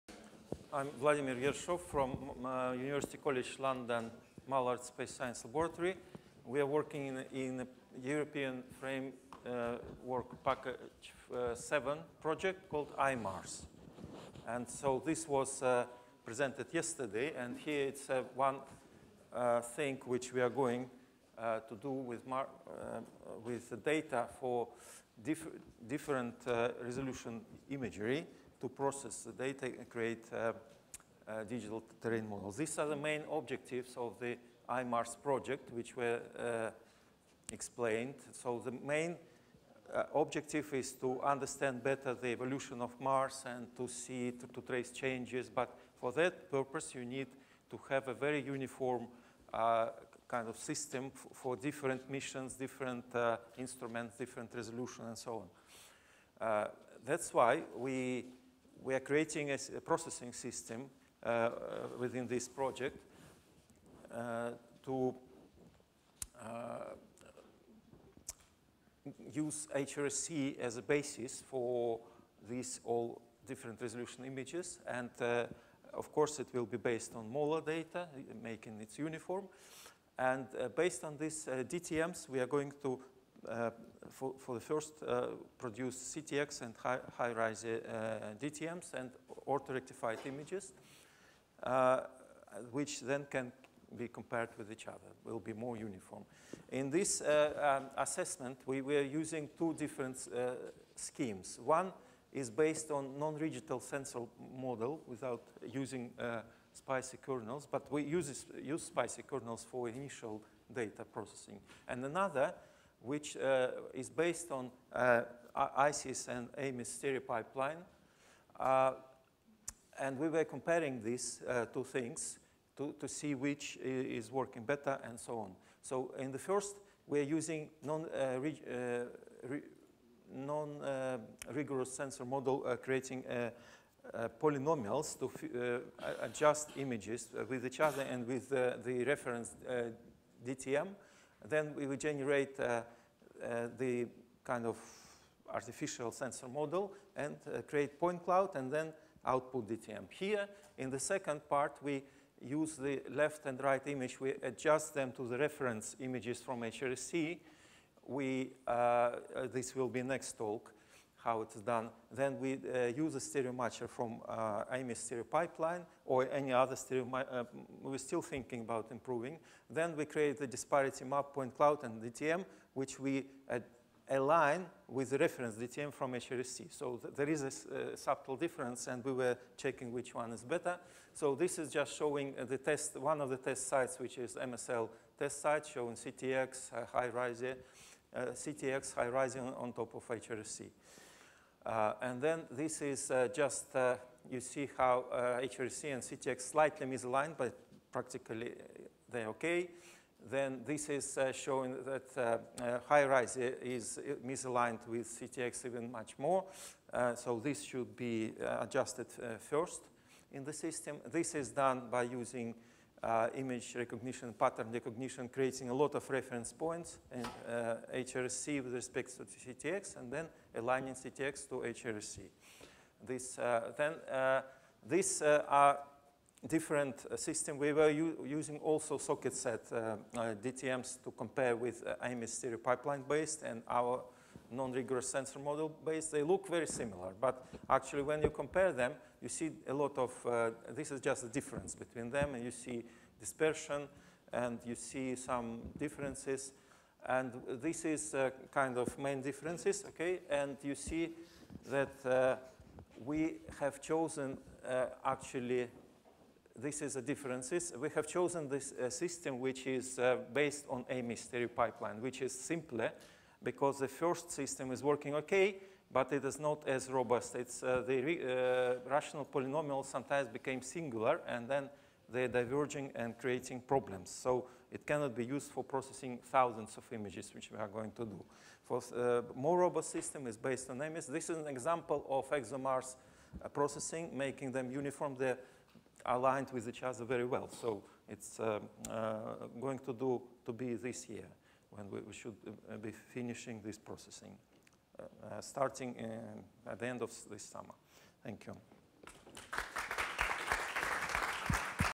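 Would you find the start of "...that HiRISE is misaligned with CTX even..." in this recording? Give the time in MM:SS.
03:21.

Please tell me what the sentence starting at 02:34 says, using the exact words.
We adjust them to the reference images from H R C.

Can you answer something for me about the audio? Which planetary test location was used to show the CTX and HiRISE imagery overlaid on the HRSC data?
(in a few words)
MSL test site.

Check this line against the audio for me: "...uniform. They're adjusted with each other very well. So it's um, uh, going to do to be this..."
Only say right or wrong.
wrong.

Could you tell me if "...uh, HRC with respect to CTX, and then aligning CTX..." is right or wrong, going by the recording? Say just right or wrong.
right.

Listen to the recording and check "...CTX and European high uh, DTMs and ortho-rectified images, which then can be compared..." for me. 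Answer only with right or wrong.
wrong.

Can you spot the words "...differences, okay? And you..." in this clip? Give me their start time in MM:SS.
04:09.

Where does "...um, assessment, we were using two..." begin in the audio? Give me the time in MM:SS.
01:37.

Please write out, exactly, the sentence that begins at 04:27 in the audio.
It's, uh, the uh, rational polynomial sometimes became singular, and then they're diverging and creating problems.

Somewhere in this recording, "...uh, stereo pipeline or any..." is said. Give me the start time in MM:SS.
02:44.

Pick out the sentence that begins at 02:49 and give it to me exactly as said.
Then we create the disparity map point cloud and DTM, which we uh, align with the reference DTM from HRSC.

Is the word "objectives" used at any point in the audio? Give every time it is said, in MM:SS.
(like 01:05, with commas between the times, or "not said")
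00:33, 00:40.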